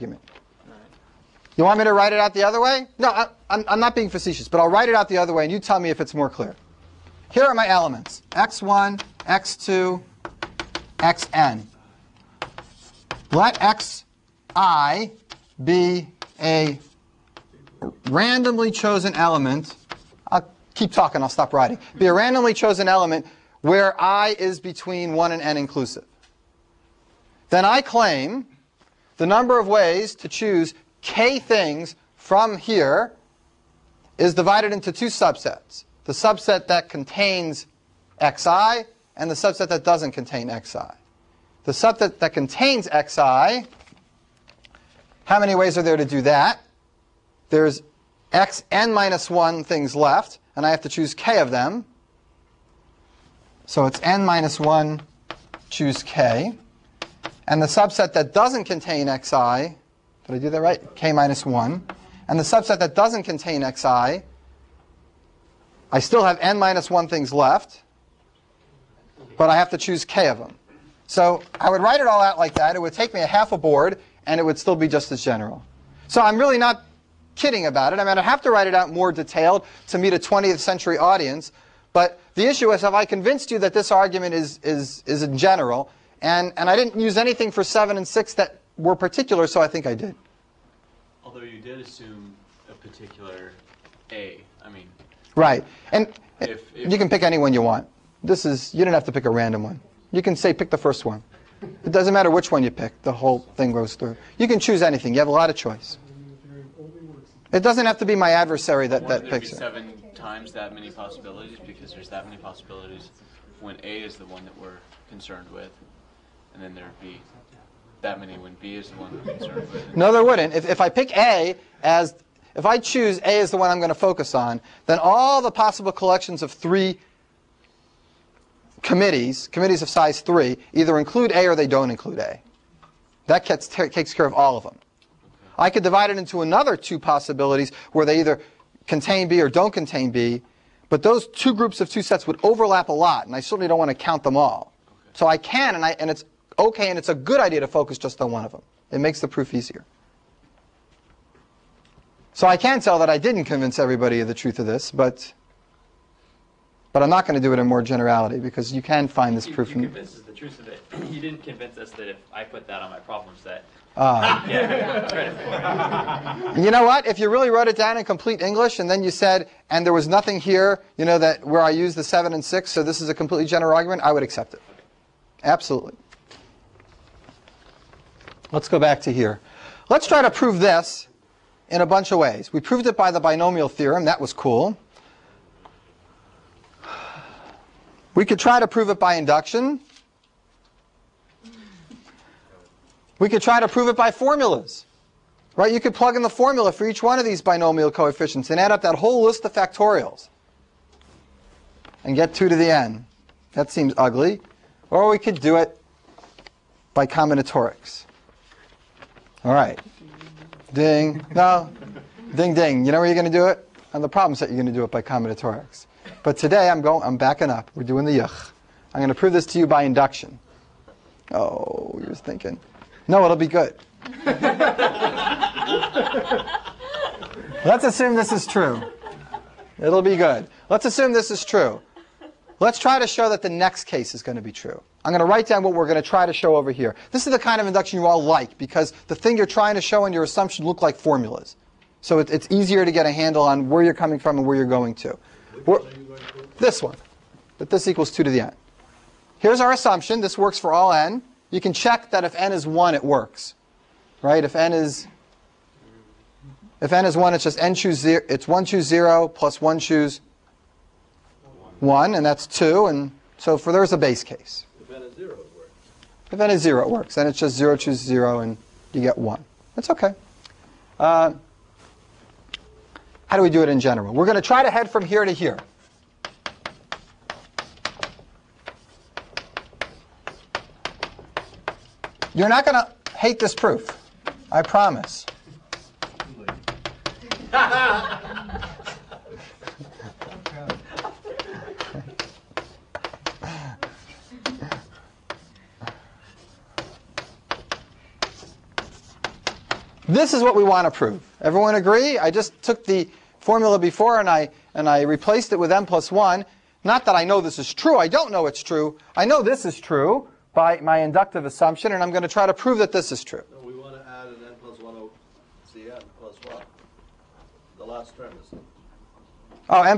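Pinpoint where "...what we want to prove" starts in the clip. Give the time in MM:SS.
05:00.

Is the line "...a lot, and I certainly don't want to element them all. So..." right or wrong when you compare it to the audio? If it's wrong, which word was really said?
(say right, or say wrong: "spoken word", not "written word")
wrong: "count", not "element".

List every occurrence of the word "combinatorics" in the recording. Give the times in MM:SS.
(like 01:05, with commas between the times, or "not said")
03:27, 03:35.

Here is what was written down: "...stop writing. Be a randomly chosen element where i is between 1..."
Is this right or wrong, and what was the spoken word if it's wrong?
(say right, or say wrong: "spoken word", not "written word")
right.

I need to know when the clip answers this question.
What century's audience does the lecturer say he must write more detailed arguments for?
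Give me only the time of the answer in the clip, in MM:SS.
01:20.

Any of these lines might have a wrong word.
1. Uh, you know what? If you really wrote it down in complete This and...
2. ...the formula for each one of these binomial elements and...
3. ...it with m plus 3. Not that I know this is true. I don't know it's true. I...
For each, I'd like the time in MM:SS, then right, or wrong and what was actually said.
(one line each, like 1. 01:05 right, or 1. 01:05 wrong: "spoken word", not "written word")
1. 02:43 wrong: "English", not "This"
2. 03:16 wrong: "coefficients", not "elements"
3. 05:05 wrong: "1", not "3".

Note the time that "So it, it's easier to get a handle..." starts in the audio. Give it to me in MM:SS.
04:02.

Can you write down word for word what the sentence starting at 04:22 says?
And so for there's a base case.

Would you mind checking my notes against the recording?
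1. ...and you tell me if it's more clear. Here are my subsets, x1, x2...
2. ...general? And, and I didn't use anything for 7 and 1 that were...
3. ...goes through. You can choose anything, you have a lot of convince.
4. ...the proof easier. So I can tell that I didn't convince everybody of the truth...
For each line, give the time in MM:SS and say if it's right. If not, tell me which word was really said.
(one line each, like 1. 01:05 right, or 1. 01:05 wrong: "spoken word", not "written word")
1. 00:05 wrong: "elements", not "subsets"
2. 01:25 wrong: "6", not "1"
3. 01:43 wrong: "choice", not "convince"
4. 02:29 right.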